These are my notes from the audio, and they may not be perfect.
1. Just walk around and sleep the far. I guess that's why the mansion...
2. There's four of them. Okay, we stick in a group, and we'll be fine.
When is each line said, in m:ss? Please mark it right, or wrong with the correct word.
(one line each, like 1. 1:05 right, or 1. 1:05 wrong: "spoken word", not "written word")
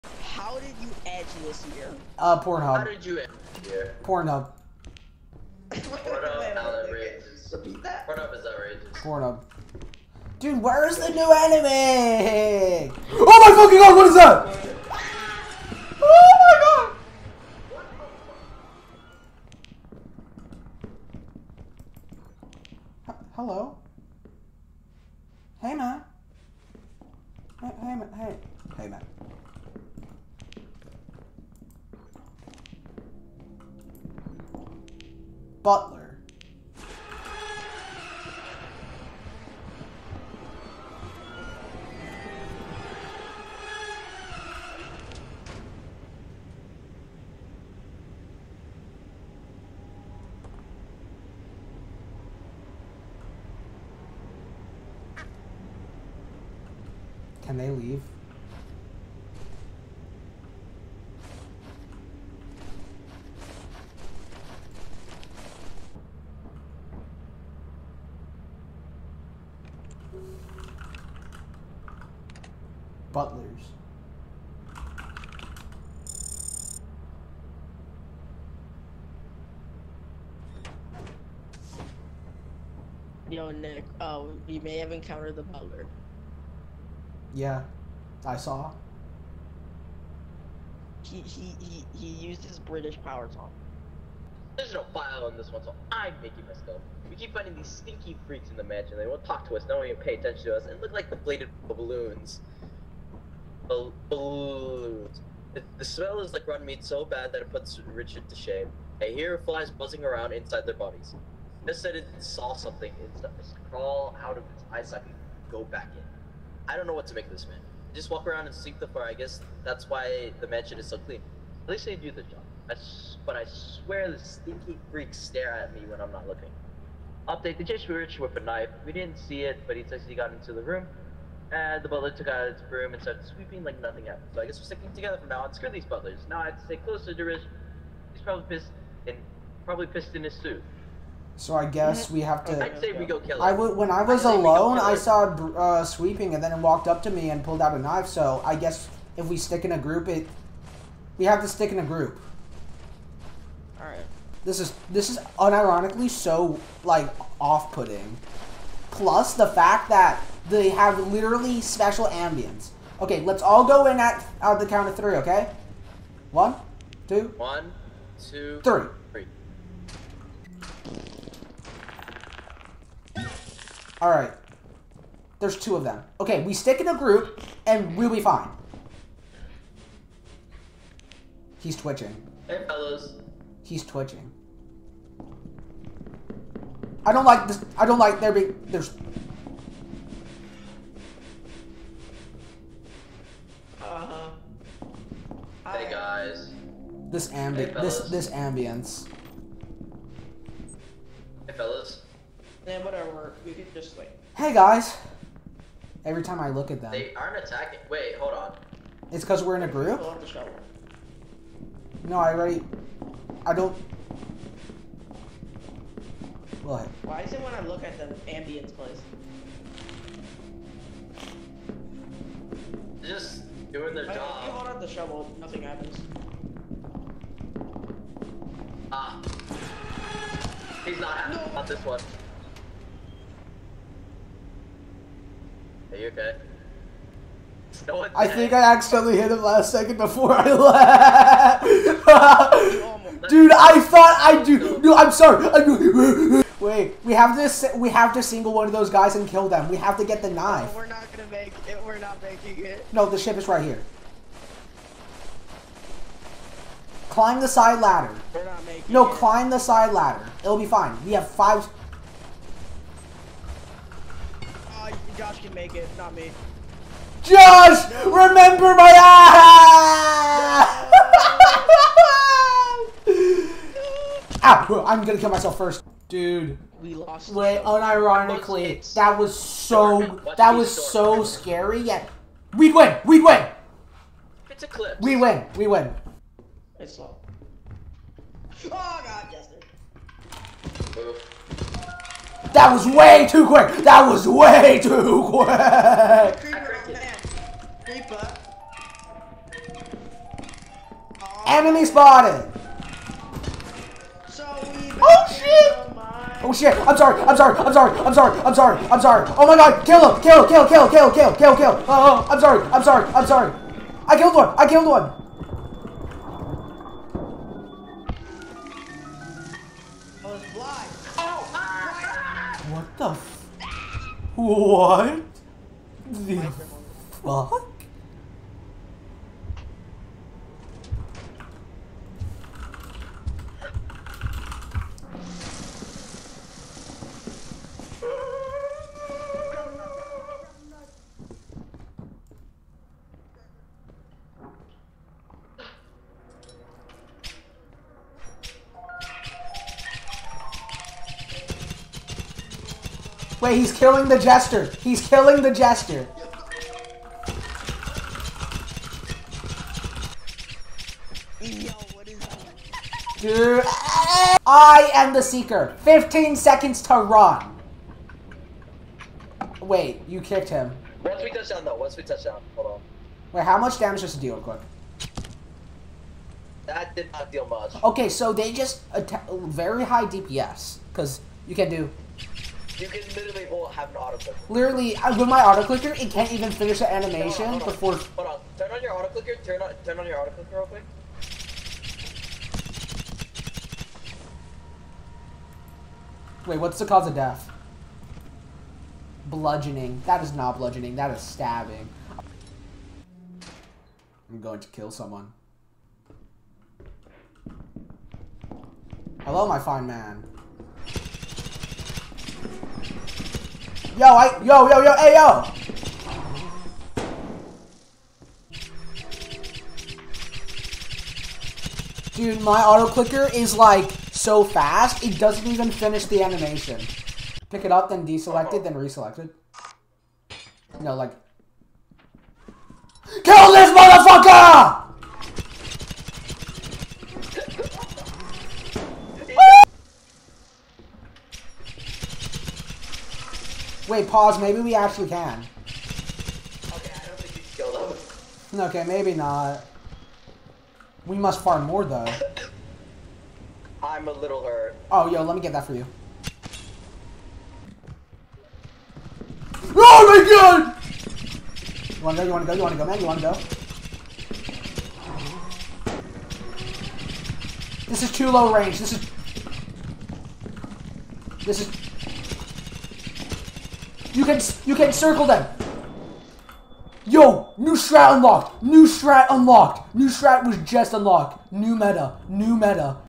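1. 1:57 right
2. 2:55 wrong: "two", not "four".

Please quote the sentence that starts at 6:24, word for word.
Literally, uh, with my auto clicker, it can't even finish the animation hold on, hold on.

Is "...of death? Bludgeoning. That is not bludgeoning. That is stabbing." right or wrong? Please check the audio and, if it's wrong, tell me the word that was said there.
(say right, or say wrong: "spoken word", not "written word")
right.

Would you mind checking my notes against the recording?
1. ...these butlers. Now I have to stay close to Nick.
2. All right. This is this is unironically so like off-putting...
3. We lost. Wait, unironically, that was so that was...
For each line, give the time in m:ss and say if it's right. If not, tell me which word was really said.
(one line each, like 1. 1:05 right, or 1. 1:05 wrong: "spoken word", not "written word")
1. 2:15 wrong: "Derish", not "Nick"
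2. 2:33 right
3. 4:36 right.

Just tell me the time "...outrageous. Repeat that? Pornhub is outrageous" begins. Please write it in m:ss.
0:06.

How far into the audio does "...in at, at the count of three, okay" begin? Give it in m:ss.
2:43.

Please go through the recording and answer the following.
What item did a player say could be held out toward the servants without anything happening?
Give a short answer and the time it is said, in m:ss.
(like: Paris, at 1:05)
The shovel, at 3:44.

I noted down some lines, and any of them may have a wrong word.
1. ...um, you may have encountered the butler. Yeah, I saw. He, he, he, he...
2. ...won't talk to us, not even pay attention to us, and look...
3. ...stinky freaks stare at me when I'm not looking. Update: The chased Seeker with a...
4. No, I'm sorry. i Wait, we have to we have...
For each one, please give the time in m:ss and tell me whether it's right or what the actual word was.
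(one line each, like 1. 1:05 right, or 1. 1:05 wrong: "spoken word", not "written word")
1. 1:24 right
2. 1:39 right
3. 2:04 wrong: "Richard", not "Seeker"
4. 4:04 right.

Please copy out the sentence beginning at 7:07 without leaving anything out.
Pick it up, then deselect it, then reselect it.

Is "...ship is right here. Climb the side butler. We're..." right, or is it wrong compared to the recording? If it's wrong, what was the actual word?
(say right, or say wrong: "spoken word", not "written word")
wrong: "ladder", not "butler".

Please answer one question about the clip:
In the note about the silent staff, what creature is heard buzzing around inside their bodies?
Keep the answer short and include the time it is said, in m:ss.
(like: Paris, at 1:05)
Flies, at 1:49.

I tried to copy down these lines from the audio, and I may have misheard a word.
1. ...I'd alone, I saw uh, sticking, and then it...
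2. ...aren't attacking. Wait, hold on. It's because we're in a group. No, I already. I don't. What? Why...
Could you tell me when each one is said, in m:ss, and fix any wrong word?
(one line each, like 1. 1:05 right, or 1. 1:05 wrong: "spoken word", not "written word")
1. 2:24 wrong: "sweeping", not "sticking"
2. 3:27 right.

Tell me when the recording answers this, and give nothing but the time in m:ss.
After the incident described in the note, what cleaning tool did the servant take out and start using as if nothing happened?
2:11.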